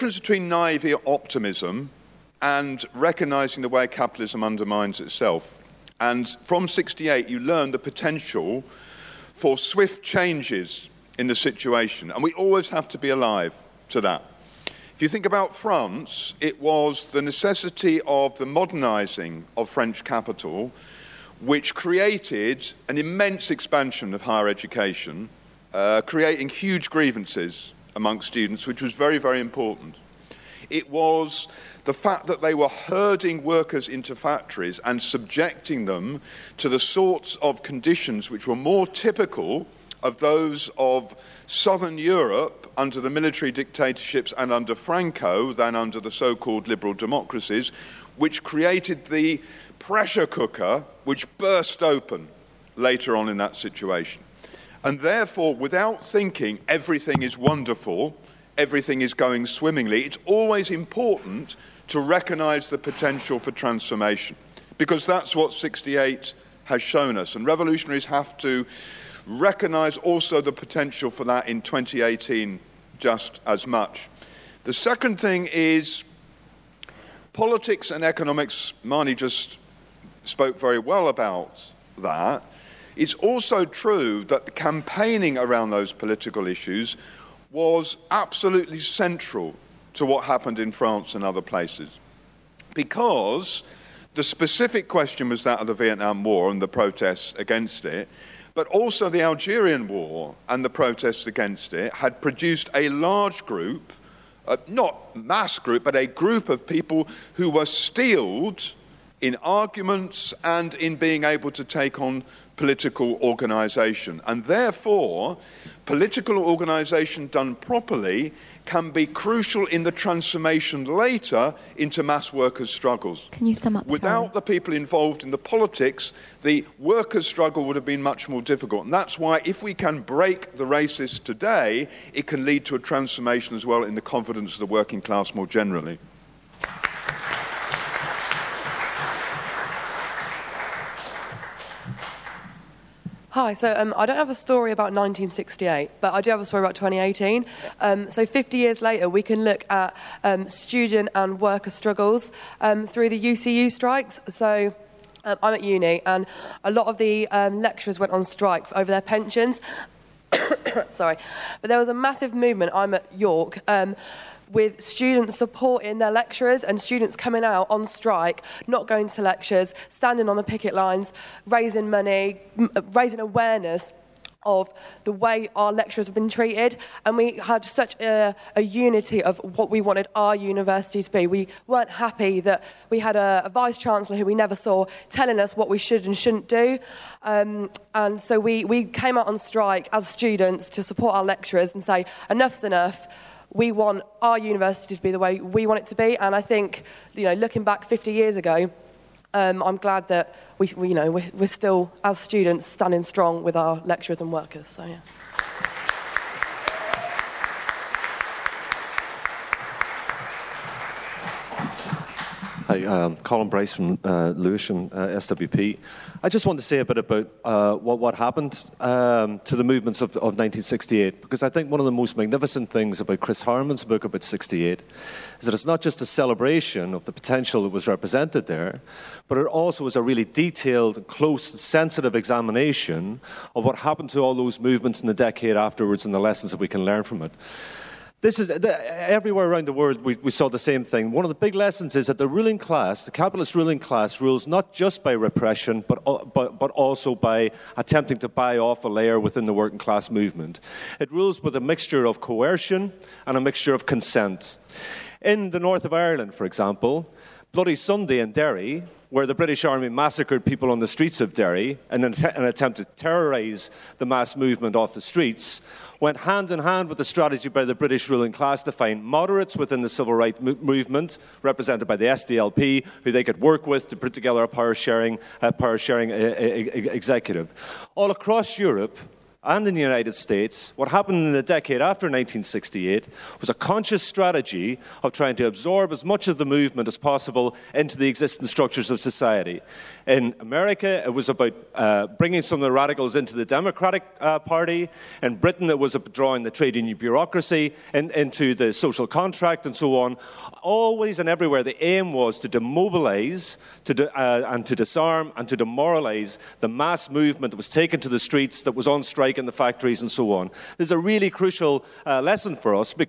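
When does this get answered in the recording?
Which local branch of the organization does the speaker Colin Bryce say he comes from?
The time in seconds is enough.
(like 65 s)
214 s.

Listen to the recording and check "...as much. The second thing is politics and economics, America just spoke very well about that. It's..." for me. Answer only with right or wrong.
wrong.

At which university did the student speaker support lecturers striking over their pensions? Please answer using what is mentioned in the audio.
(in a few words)
York.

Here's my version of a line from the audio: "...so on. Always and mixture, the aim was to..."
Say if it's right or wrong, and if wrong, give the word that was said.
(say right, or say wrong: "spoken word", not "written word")
wrong: "everywhere", not "mixture".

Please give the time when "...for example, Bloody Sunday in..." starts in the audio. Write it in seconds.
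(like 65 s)
256 s.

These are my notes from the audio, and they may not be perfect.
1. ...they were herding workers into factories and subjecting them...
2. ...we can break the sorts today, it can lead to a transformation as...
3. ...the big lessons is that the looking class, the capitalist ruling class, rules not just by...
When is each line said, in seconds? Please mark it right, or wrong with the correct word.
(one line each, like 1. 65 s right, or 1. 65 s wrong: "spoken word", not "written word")
1. 32 s right
2. 129 s wrong: "racists", not "sorts"
3. 241 s wrong: "ruling", not "looking".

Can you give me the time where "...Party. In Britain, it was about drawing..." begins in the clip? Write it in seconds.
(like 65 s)
294 s.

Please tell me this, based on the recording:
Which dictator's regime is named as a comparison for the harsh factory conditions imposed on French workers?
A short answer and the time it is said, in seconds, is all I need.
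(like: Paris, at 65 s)
Franco, at 44 s.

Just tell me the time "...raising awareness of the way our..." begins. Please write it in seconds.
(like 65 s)
172 s.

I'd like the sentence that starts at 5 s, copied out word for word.
And from 68, you learn the potential for swift changes in the situation.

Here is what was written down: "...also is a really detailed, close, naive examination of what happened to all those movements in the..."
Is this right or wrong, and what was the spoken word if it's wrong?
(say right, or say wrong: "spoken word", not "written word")
wrong: "sensitive", not "naive".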